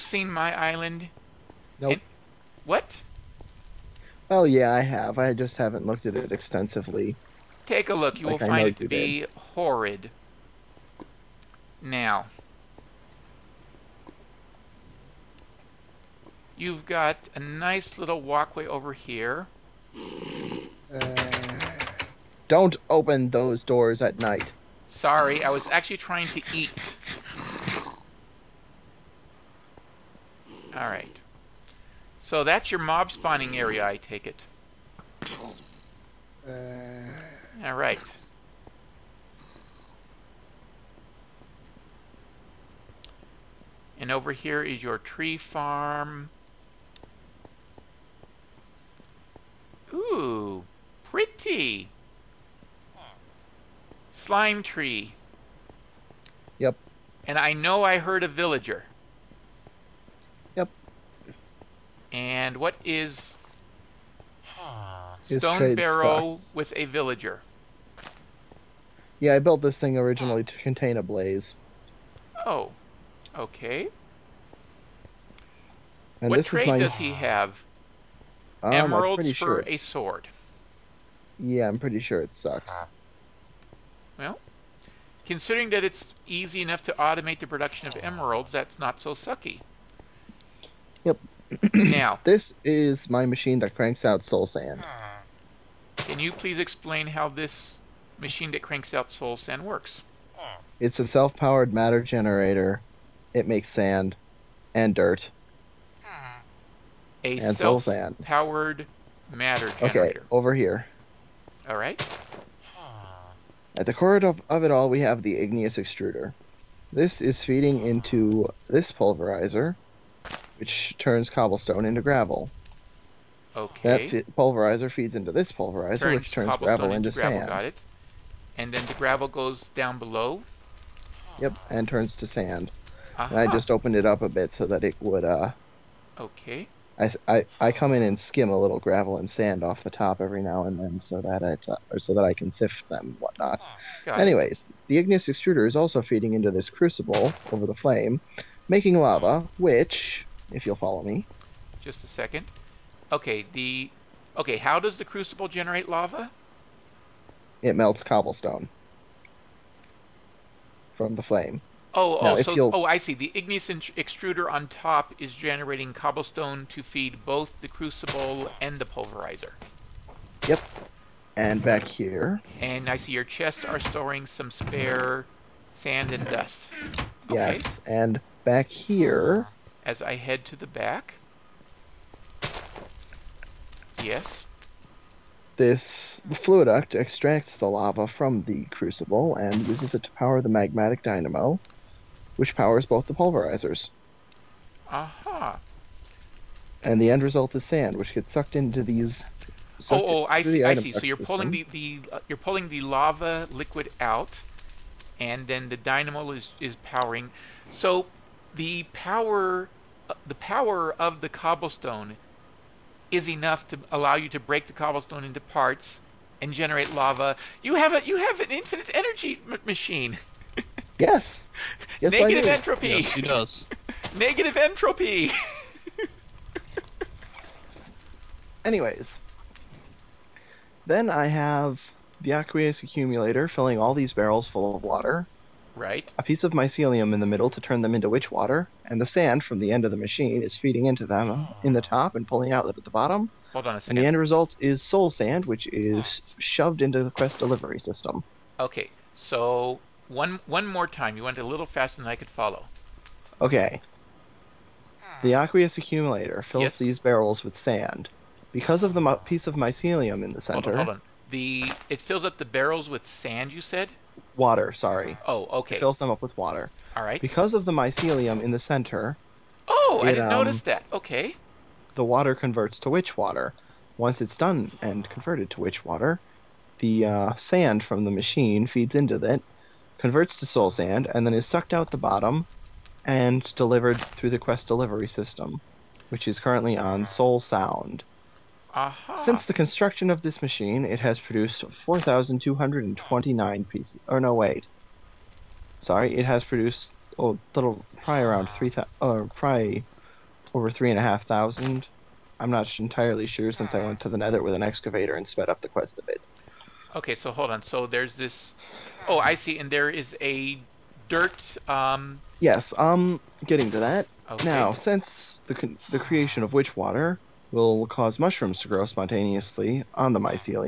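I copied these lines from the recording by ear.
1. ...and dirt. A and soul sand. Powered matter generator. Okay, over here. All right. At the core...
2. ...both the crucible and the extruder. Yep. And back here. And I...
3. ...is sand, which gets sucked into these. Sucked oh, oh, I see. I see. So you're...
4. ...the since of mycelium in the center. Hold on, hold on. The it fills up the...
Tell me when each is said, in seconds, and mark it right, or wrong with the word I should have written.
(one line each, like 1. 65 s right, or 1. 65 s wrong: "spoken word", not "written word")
1. 104 s right
2. 167 s wrong: "pulverizer", not "extruder"
3. 197 s right
4. 258 s wrong: "piece", not "since".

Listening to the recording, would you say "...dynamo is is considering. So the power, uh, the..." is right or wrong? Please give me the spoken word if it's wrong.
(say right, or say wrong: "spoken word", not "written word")
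wrong: "powering", not "considering".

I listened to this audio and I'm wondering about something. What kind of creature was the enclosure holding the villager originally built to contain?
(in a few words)
a blaze.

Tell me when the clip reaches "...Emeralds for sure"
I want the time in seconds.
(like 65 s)
78 s.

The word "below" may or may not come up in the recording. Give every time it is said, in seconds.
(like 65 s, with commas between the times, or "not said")
129 s.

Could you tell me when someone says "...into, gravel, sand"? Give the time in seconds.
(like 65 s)
126 s.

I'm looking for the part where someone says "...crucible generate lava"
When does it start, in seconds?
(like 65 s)
155 s.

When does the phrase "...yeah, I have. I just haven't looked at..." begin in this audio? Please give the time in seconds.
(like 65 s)
4 s.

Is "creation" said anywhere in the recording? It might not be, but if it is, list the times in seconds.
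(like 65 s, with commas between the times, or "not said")
315 s.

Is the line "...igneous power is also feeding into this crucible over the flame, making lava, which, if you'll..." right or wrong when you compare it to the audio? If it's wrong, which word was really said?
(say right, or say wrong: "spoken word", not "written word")
wrong: "extruder", not "power".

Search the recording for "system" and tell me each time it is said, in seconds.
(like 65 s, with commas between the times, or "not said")
247 s, 285 s.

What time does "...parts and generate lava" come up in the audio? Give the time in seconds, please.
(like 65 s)
215 s.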